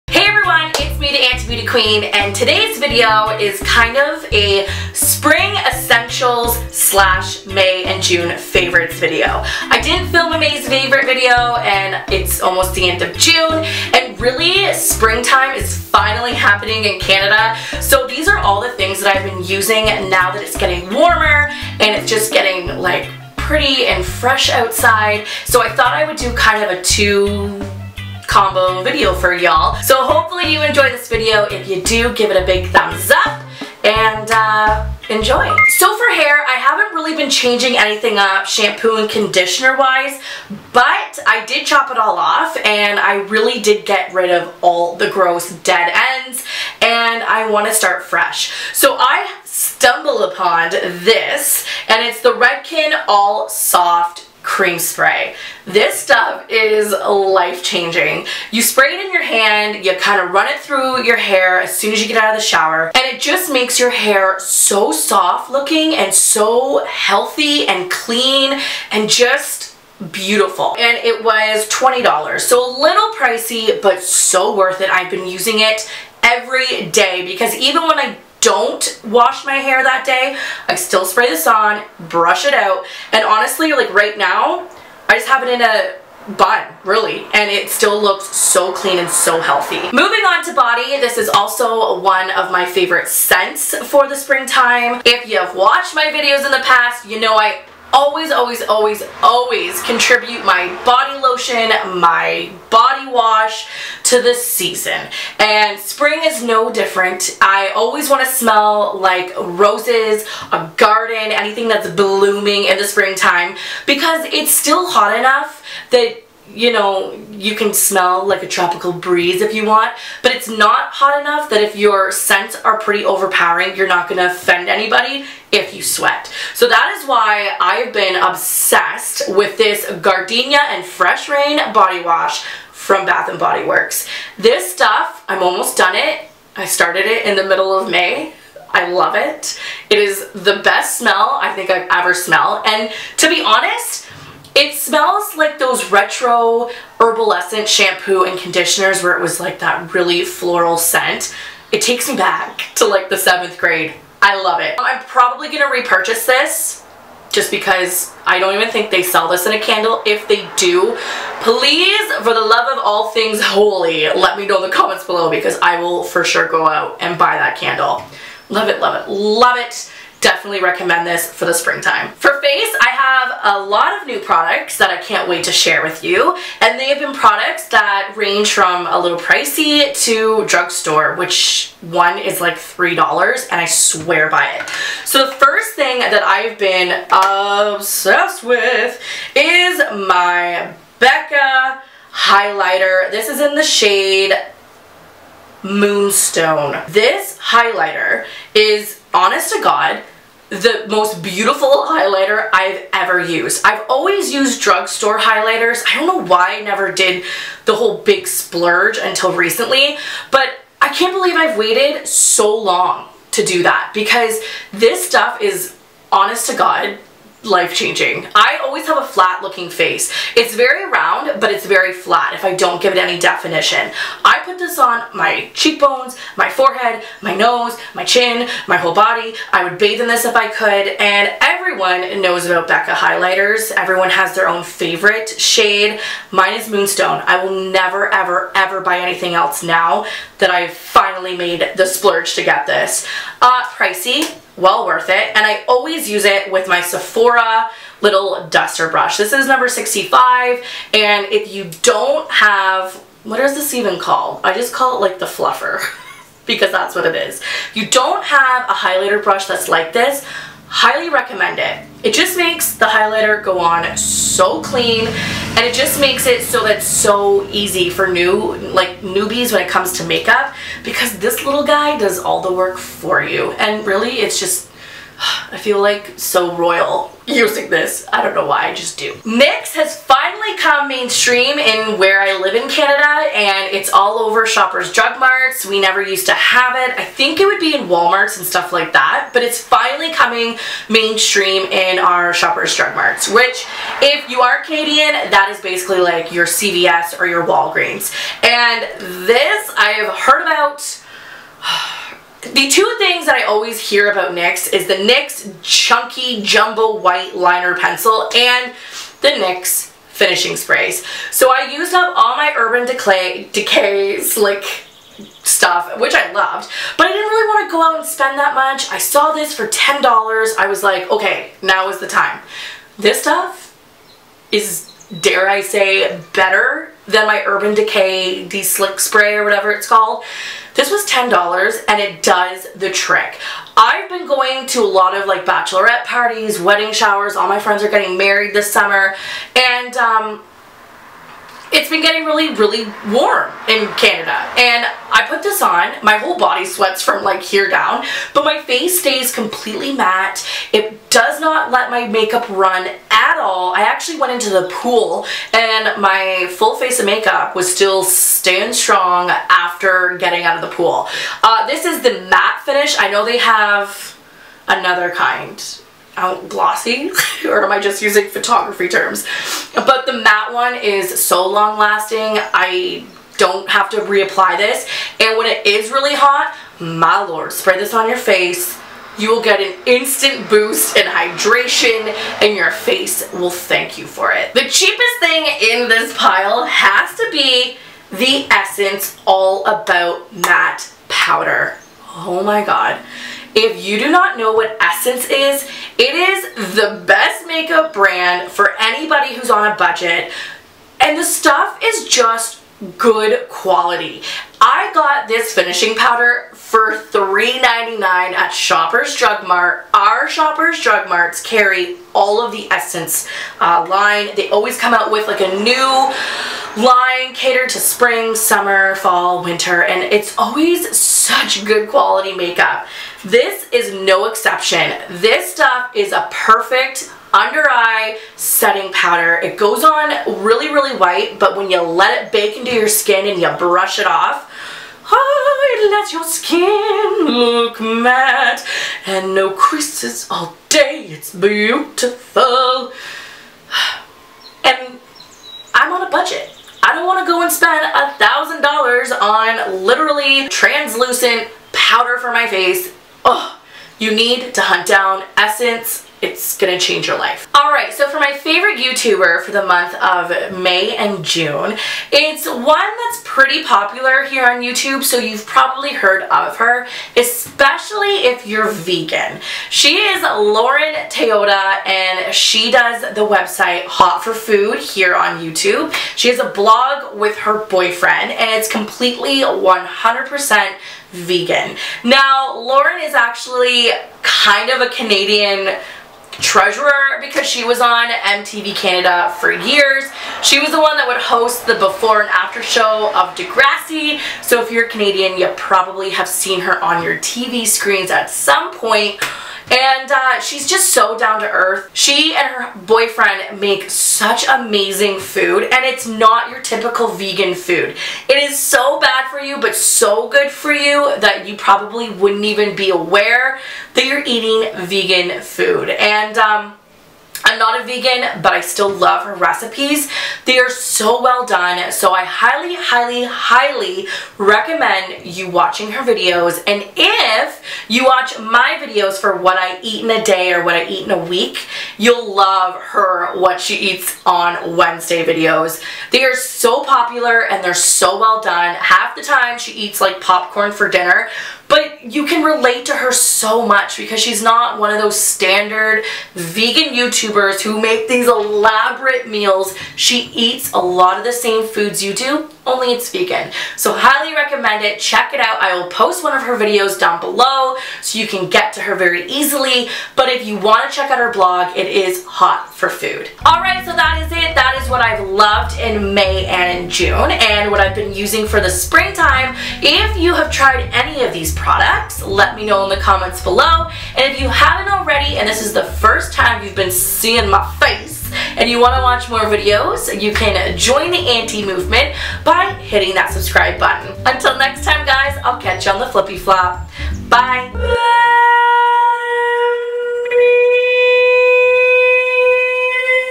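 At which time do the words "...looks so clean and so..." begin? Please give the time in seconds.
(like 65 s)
88 s.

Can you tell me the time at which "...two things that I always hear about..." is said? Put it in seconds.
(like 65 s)
302 s.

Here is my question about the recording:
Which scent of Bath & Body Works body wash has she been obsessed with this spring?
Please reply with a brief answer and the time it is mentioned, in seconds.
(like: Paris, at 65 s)
Gardenia and Fresh Rain, at 130 s.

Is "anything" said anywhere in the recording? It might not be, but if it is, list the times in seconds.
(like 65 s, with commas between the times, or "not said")
37 s, 111 s, 238 s.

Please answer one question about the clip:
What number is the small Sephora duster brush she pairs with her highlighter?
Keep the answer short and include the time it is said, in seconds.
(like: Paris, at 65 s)
65, at 249 s.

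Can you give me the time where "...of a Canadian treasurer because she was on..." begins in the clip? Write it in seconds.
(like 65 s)
484 s.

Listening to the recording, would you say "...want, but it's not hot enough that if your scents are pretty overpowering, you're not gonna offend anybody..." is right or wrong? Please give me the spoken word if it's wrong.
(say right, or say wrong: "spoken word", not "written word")
right.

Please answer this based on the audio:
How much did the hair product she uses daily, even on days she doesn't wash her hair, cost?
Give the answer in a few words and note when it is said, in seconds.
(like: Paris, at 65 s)
$20, at 71 s.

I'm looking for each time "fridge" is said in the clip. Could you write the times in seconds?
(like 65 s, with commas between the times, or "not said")
not said.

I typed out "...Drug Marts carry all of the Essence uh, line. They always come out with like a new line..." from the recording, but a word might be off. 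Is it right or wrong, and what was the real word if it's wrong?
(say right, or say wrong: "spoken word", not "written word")
right.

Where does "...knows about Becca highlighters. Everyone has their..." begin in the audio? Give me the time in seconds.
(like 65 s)
232 s.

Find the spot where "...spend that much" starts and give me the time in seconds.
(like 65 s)
318 s.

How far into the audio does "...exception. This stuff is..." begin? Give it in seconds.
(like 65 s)
424 s.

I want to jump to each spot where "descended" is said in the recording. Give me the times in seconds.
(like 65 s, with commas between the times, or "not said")
not said.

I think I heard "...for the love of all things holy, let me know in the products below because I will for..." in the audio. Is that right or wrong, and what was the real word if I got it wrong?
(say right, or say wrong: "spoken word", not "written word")
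wrong: "comments", not "products".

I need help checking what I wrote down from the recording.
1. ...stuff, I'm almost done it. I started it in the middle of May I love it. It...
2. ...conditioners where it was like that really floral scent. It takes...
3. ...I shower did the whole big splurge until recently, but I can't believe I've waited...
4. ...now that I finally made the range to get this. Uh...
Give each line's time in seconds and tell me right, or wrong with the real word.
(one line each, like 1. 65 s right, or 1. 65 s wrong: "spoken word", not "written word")
1. 134 s right
2. 148 s right
3. 206 s wrong: "never", not "shower"
4. 239 s wrong: "splurge", not "range".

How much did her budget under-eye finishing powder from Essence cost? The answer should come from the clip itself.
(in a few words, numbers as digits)
$3.99.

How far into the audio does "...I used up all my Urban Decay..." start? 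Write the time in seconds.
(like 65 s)
311 s.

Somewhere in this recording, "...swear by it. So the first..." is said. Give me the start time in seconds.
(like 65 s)
183 s.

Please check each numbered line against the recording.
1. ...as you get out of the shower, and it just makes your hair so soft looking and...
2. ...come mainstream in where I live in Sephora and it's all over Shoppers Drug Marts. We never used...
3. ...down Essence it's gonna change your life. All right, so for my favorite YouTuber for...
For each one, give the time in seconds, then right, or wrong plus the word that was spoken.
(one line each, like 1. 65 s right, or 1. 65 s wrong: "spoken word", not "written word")
1. 61 s right
2. 280 s wrong: "Canada", not "Sephora"
3. 454 s right.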